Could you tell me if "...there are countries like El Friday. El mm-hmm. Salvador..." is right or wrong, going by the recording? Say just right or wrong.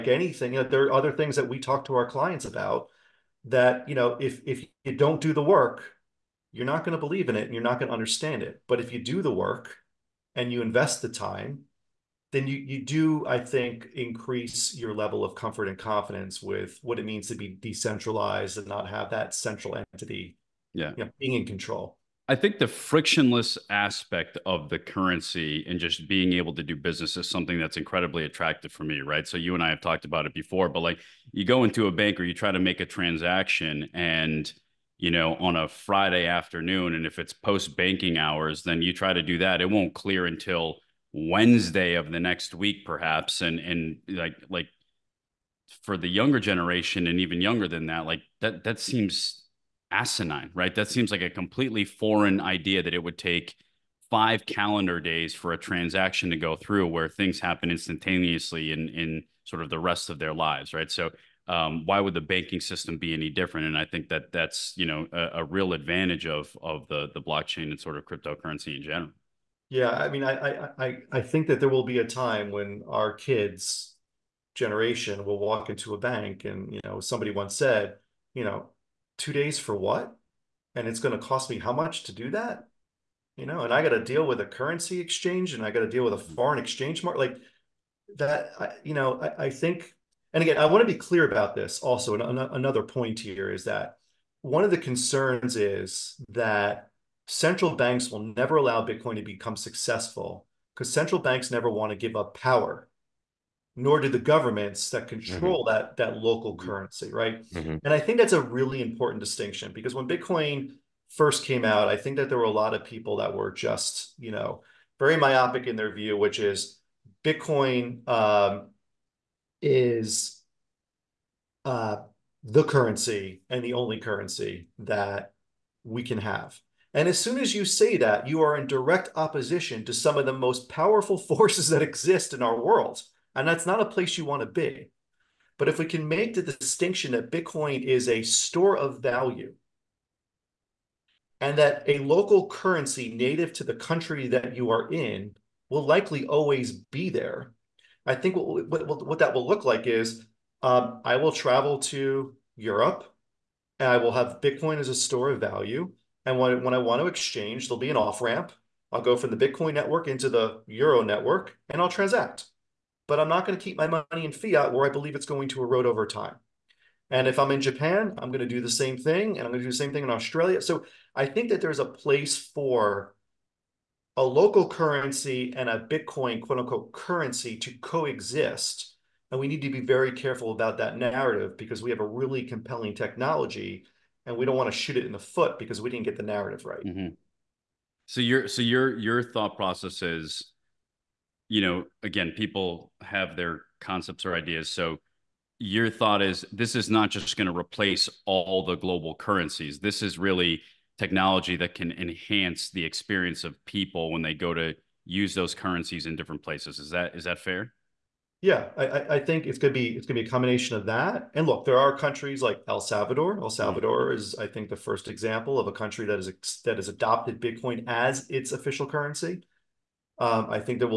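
wrong.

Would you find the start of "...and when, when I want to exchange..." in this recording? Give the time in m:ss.
2:36.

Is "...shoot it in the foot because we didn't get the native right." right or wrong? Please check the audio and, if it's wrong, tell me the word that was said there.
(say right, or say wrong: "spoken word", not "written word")
wrong: "narrative", not "native".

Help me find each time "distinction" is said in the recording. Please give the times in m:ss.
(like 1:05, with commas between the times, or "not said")
1:49, 2:16.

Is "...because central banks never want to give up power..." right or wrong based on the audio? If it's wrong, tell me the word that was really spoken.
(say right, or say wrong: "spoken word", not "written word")
right.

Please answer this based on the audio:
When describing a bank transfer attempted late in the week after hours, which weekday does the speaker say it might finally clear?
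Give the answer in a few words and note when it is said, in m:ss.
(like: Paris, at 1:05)
Wednesday, at 0:41.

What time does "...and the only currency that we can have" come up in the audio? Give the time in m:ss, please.
2:03.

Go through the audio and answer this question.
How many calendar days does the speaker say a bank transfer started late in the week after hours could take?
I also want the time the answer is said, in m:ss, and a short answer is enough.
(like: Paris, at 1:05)
5, at 0:54.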